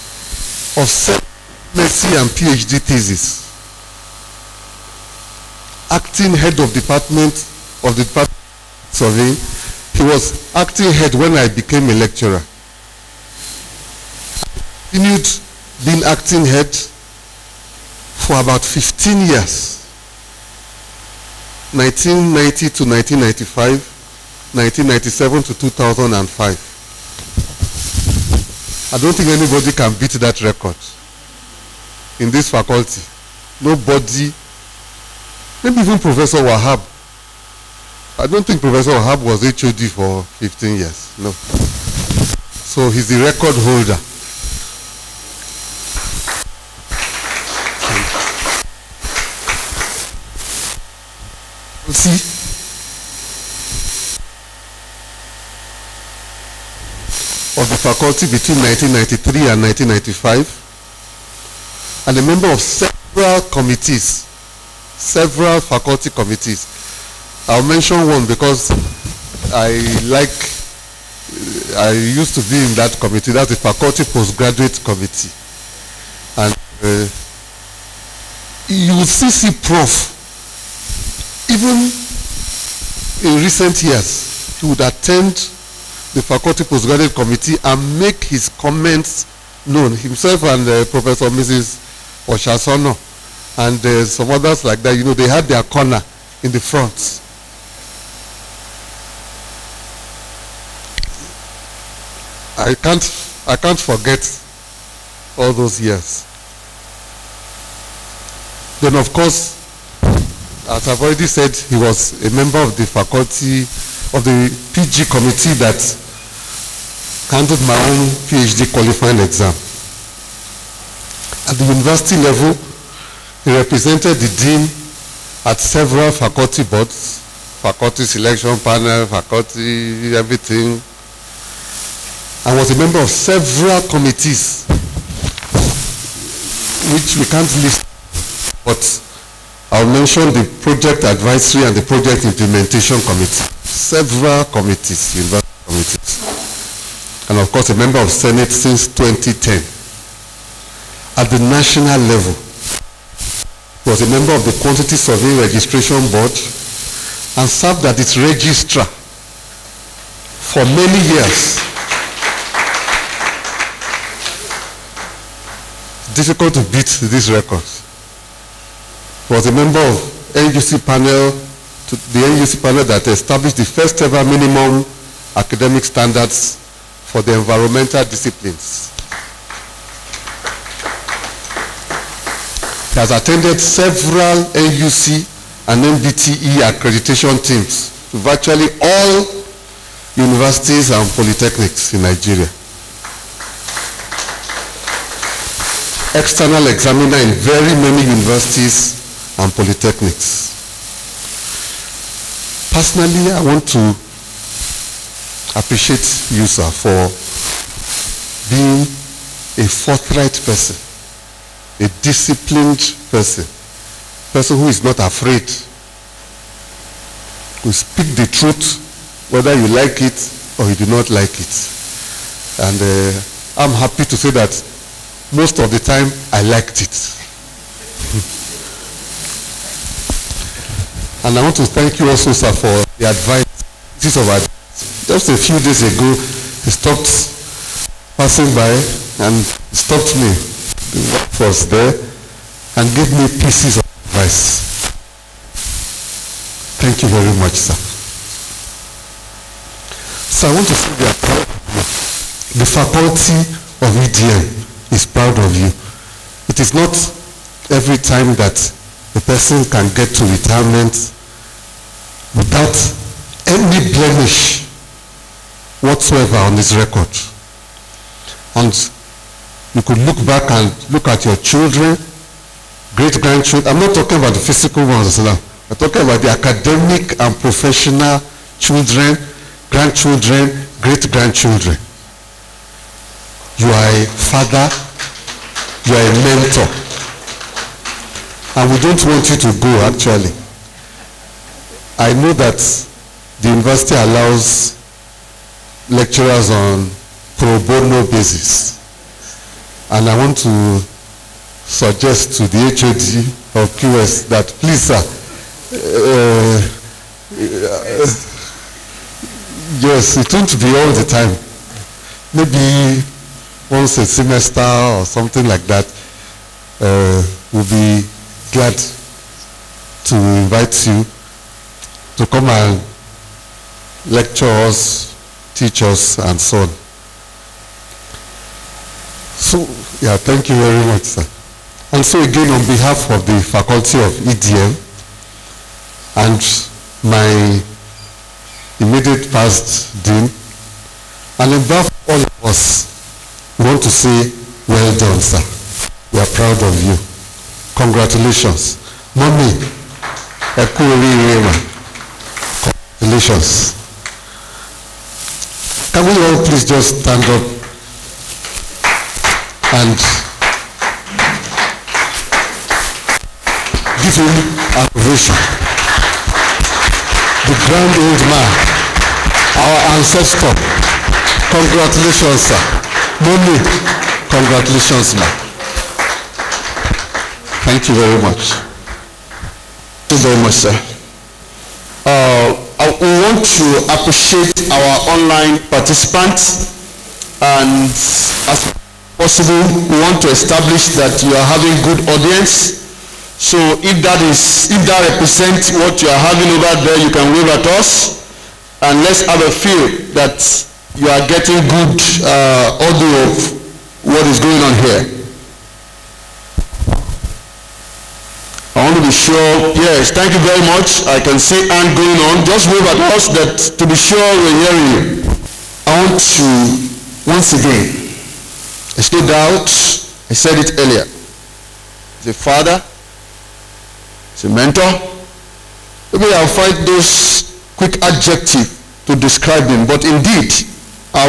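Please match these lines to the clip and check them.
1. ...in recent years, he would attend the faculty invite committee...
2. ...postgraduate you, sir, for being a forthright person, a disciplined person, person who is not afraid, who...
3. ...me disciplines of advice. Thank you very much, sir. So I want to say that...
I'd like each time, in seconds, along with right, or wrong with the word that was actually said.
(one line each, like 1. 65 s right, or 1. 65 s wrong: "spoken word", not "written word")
1. 83 s wrong: "postgraduate", not "invite"
2. 205 s wrong: "appreciate", not "postgraduate"
3. 243 s wrong: "pieces", not "disciplines".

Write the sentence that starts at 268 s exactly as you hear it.
And you could look back and look at your children, great-grandchildren.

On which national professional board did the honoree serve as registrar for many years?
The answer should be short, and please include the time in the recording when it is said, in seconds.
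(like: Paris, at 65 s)
Quantity Survey Registration Board, at 154 s.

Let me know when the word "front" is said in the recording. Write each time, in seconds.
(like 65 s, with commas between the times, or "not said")
96 s.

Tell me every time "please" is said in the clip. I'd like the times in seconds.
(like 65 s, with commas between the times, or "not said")
304 s, 356 s.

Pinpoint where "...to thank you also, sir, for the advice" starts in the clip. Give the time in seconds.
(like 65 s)
231 s.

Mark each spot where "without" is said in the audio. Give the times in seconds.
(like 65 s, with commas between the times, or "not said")
262 s.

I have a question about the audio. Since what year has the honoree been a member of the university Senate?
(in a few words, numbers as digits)
2010.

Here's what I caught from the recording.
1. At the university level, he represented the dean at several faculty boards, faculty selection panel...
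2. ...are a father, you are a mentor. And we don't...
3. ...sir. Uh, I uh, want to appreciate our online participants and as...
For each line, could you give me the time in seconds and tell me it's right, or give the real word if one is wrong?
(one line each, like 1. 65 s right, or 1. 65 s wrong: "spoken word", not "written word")
1. 121 s right
2. 283 s right
3. 380 s right.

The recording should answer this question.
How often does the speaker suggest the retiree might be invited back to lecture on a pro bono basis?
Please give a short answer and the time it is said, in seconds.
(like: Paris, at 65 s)
once a semester, at 313 s.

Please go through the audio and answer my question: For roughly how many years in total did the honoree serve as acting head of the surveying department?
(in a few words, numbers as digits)
15 years.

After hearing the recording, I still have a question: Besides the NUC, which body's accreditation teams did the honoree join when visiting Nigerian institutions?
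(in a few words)
NBTE.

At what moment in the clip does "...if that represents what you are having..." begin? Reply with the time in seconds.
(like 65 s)
394 s.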